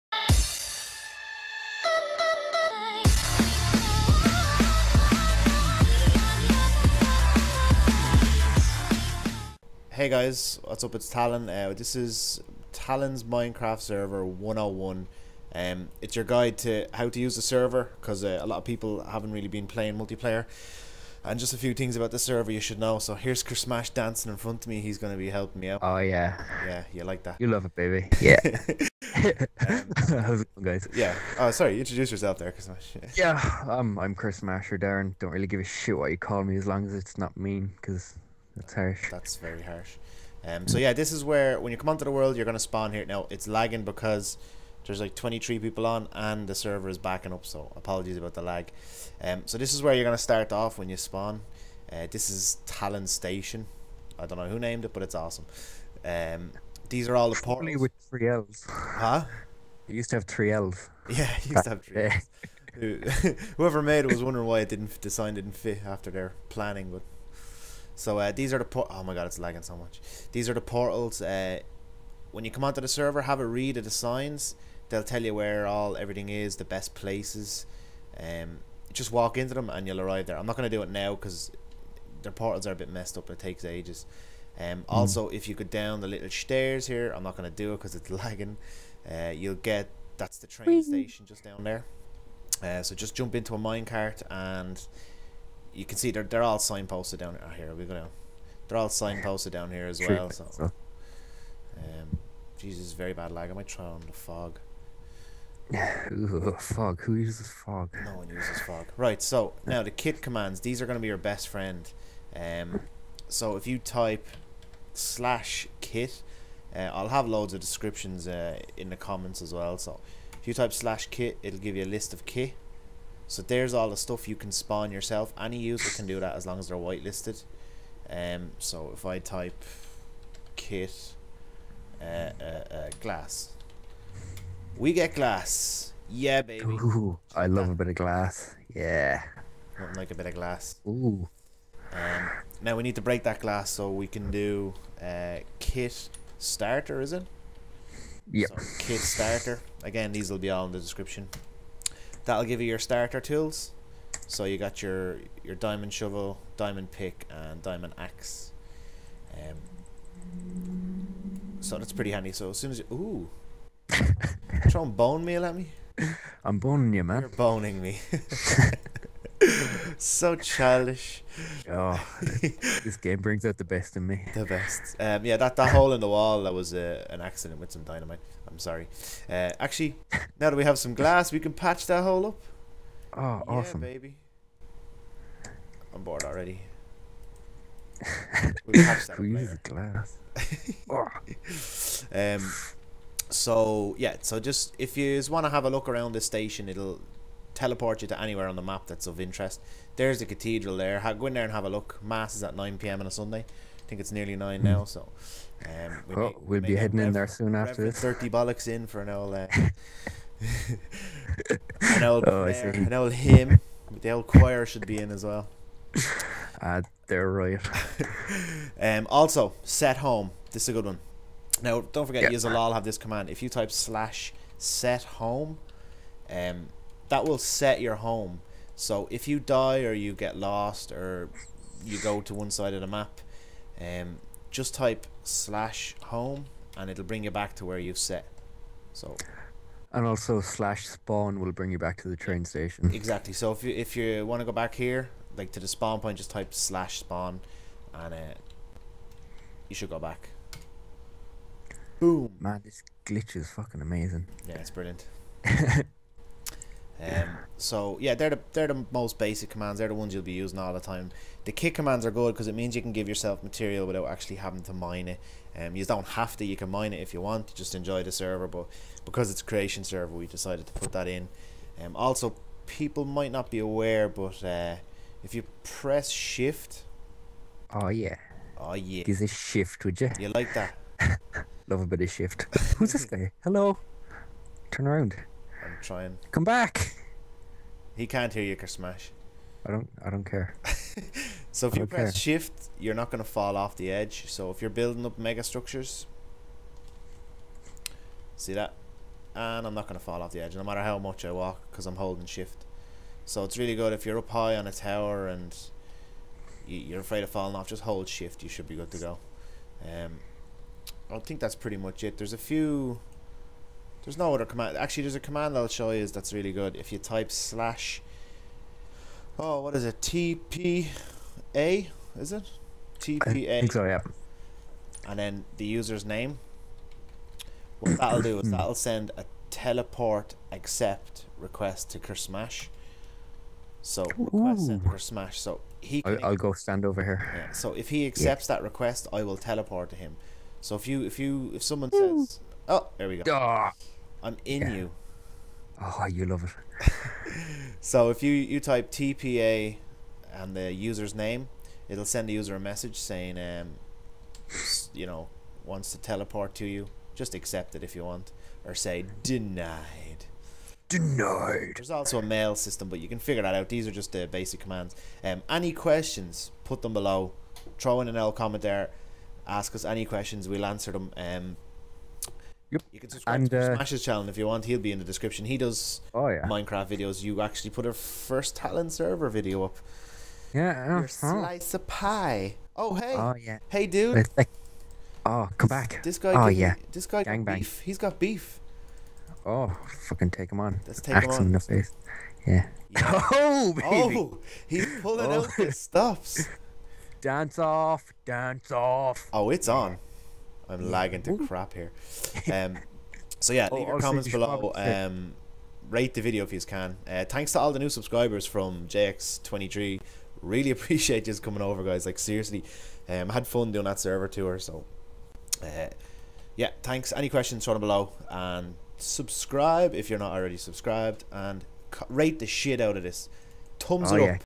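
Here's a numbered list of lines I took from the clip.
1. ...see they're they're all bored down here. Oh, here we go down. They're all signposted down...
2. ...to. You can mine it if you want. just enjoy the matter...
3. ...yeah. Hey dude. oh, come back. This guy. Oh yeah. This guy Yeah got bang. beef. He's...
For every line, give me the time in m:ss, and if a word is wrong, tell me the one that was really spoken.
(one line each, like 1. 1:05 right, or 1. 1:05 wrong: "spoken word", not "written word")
1. 1:35 wrong: "signposted", not "bored"
2. 4:26 wrong: "server", not "matter"
3. 6:23 wrong: "Gang", not "Yeah".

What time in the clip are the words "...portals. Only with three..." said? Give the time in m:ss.
0:57.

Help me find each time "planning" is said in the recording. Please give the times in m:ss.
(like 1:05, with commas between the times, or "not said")
1:06.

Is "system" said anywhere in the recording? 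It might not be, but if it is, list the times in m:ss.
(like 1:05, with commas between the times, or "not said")
6:02.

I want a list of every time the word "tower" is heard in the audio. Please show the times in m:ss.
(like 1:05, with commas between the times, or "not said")
5:04.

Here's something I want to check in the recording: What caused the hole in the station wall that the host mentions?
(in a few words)
dynamite.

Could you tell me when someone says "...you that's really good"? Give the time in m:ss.
5:15.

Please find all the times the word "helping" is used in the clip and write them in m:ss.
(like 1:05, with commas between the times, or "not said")
0:25.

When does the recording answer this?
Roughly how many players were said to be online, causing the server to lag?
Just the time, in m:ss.
0:45.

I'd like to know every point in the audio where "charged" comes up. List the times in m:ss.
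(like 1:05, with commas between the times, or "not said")
not said.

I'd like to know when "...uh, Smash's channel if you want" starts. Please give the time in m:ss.
6:13.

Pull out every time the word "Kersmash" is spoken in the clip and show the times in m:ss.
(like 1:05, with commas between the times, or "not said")
0:23, 0:32.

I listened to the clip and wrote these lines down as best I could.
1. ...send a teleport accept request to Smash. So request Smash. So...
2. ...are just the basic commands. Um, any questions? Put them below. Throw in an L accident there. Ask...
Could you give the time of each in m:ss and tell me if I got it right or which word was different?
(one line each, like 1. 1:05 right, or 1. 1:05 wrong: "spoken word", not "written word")
1. 5:28 right
2. 6:03 wrong: "comment", not "accident".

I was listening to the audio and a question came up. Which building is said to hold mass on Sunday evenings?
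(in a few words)
the cathedral.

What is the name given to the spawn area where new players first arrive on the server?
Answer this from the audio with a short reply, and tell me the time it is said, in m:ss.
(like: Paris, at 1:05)
Tallon Station, at 0:52.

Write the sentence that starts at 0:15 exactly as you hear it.
Um, it's your guide to how to use the server because uh, a lot of people haven't really been playing multiplayer.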